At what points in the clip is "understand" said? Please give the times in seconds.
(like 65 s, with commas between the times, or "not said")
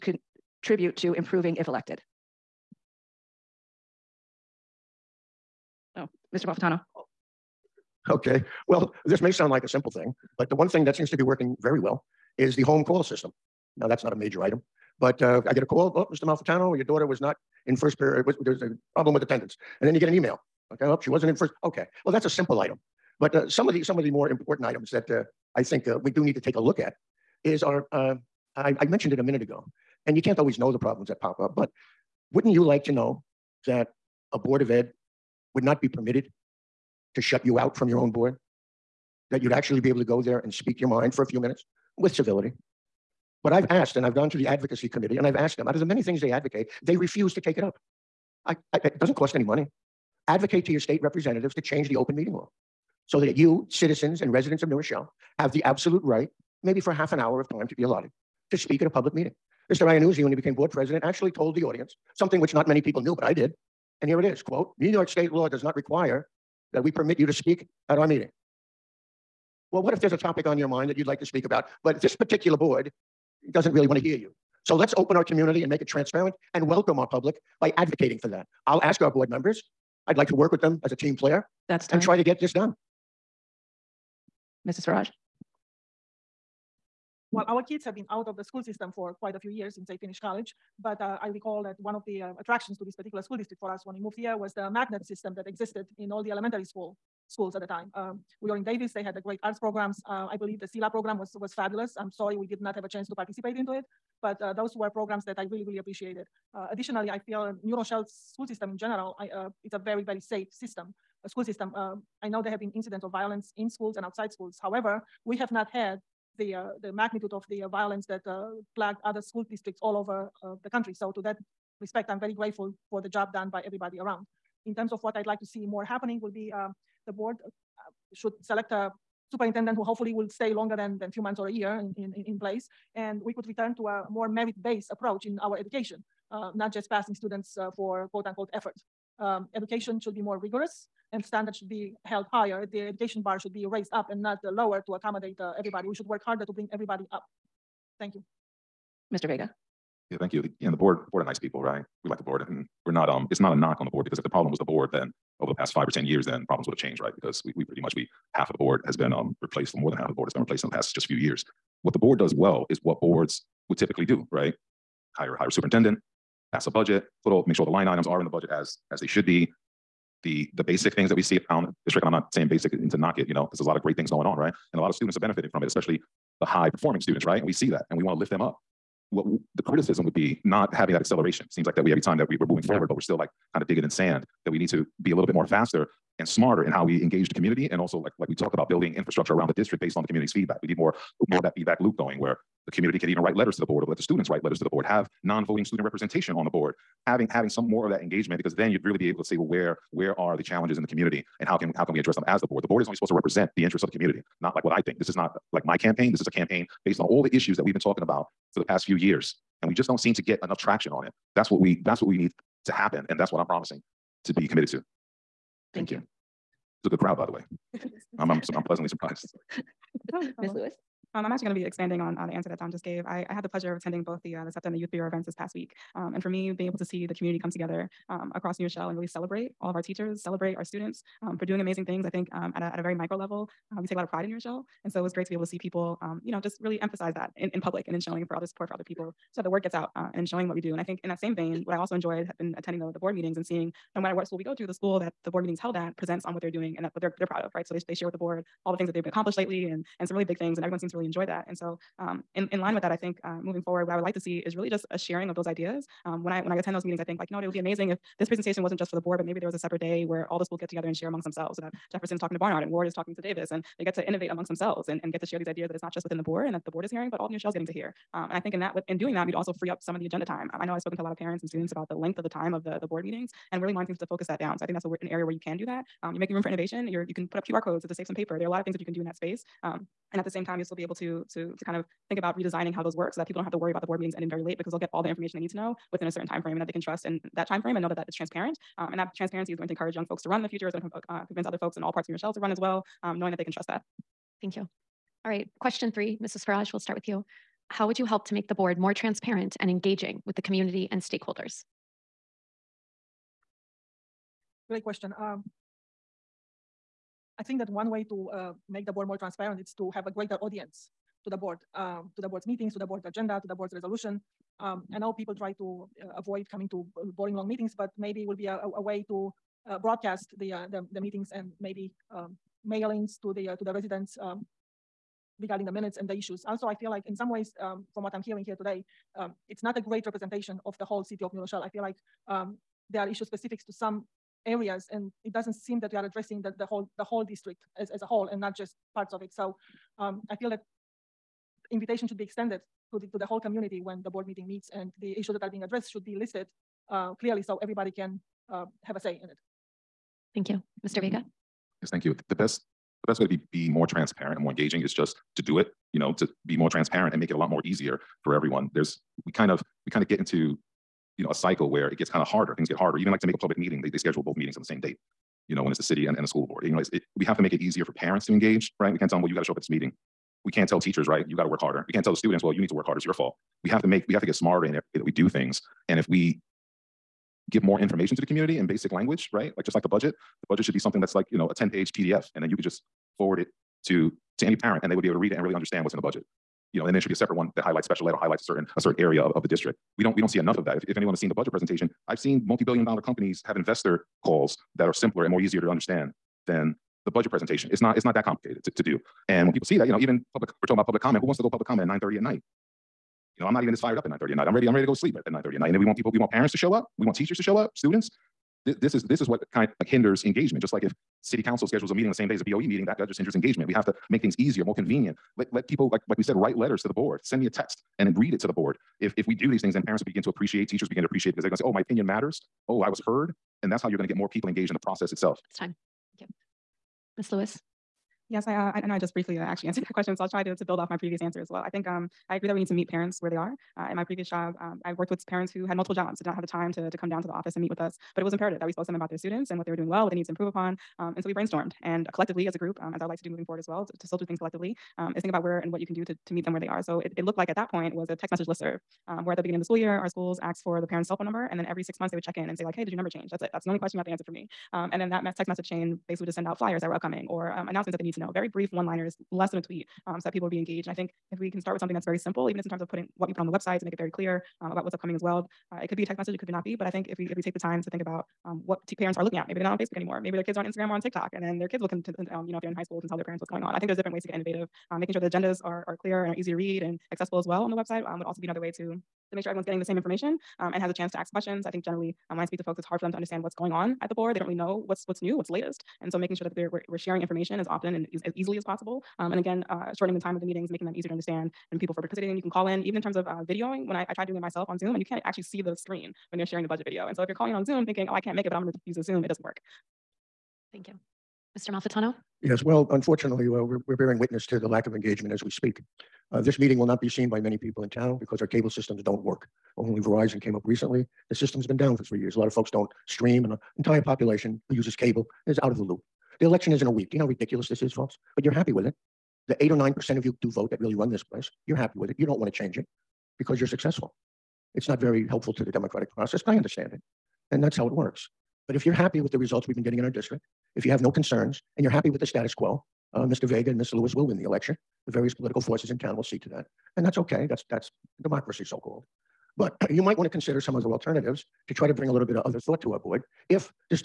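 385 s, 395 s, 483 s, 491 s, 526 s.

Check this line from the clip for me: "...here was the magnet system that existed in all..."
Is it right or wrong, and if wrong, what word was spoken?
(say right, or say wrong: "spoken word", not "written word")
right.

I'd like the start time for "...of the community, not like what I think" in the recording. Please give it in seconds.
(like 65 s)
203 s.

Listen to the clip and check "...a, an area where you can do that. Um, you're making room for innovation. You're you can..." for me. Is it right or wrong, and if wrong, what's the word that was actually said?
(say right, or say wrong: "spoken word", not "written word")
right.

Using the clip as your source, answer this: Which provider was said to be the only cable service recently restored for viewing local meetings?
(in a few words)
Verizon.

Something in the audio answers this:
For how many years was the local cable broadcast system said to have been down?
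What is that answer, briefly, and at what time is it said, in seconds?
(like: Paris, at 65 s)
3, at 512 s.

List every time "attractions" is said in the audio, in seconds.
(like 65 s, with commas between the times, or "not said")
92 s.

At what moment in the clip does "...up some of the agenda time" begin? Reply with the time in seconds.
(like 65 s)
269 s.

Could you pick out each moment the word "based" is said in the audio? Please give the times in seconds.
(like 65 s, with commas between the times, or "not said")
134 s, 189 s, 206 s.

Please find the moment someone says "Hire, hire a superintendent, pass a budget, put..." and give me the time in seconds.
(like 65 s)
165 s.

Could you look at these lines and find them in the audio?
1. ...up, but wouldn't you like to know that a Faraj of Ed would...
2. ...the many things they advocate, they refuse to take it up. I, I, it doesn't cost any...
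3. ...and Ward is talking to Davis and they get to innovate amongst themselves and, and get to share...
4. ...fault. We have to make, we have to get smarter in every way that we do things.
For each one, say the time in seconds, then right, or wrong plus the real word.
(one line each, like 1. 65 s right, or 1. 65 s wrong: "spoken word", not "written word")
1. 31 s wrong: "Board", not "Faraj"
2. 45 s right
3. 262 s right
4. 373 s right.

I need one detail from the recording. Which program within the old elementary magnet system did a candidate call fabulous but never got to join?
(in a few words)
SILA.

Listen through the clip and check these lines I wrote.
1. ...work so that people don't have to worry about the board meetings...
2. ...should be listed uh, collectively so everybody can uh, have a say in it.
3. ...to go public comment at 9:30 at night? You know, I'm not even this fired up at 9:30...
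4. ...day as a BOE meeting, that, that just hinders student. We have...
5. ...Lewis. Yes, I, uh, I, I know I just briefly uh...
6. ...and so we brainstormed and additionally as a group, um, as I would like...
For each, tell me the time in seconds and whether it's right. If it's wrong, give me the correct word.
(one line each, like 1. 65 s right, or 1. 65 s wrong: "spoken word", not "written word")
1. 282 s right
2. 345 s wrong: "clearly", not "collectively"
3. 401 s right
4. 412 s wrong: "engagement", not "student"
5. 427 s right
6. 441 s wrong: "collectively", not "additionally".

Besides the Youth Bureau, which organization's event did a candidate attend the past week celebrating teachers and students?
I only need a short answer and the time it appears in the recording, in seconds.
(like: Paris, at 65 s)
SEPTA, at 224 s.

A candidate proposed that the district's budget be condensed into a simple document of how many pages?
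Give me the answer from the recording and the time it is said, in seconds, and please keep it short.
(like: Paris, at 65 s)
10, at 381 s.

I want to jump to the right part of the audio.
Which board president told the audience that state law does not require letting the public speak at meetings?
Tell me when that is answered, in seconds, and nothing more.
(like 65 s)
59 s.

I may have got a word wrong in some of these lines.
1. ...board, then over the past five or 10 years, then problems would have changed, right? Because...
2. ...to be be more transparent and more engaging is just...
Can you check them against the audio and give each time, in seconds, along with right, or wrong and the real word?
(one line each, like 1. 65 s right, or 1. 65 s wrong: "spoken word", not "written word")
1. 154 s right
2. 353 s right.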